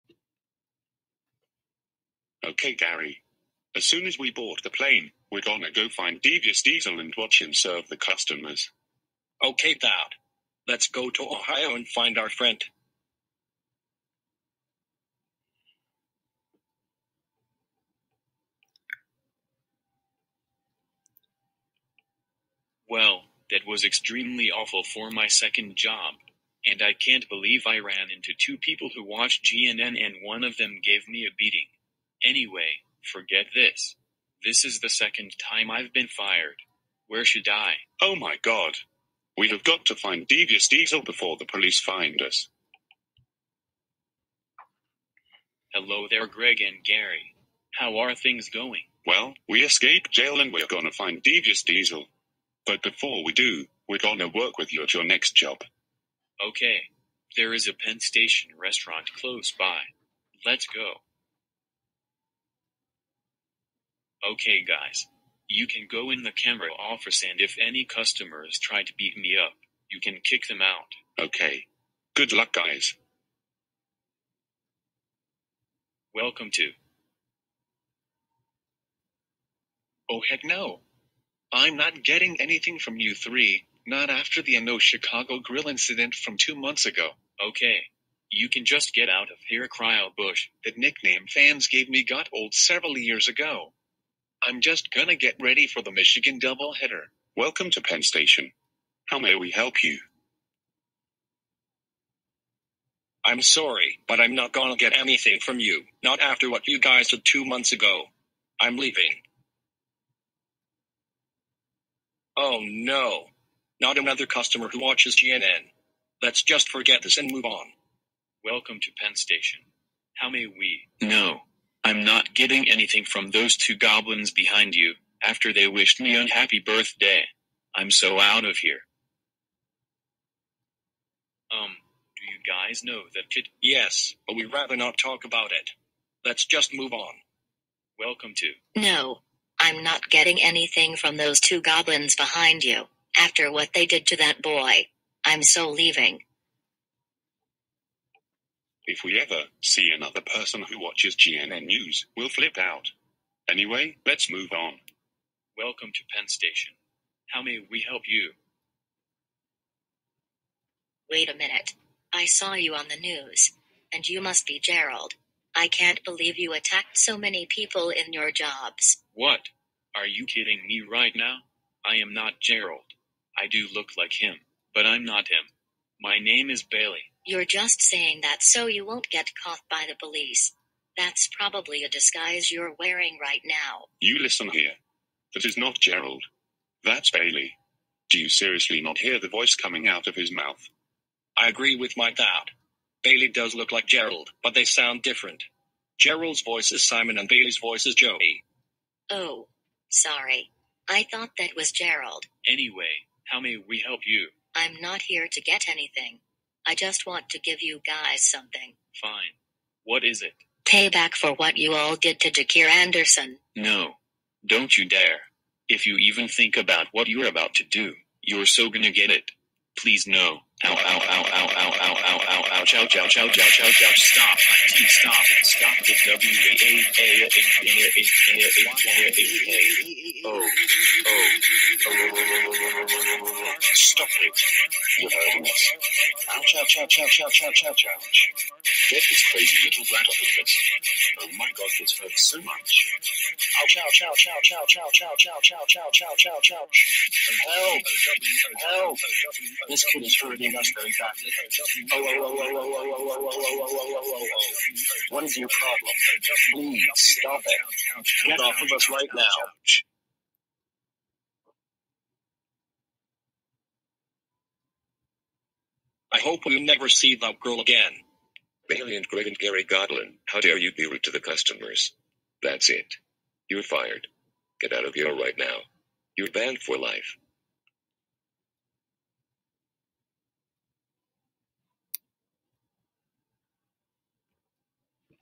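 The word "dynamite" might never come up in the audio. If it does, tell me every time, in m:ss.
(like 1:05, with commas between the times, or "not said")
not said.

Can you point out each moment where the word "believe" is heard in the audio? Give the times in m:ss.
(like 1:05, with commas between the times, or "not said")
0:27, 2:46.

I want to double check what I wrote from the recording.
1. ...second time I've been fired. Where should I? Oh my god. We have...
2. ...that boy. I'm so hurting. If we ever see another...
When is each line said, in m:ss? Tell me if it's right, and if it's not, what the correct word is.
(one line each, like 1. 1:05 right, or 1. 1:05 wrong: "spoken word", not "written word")
1. 0:34 right
2. 2:24 wrong: "leaving", not "hurting".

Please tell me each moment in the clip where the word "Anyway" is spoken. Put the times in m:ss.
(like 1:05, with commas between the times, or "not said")
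0:32, 2:33, 3:22.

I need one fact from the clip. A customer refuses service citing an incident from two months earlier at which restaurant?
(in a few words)
Uno Chicago Grill.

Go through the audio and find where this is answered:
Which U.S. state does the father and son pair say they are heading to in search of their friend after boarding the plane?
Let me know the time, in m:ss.
0:11.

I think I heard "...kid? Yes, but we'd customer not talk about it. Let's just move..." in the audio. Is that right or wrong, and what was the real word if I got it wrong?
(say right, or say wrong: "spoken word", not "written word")
wrong: "rather", not "customer".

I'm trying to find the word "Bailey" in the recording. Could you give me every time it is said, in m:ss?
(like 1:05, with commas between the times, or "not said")
2:56, 3:07, 3:13, 3:17.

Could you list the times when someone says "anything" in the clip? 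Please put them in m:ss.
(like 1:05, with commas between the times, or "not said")
1:22, 1:44, 2:02, 2:20, 3:25.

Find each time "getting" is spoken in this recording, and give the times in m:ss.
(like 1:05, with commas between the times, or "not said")
1:22, 2:02, 2:20.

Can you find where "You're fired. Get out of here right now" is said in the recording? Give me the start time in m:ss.
4:33.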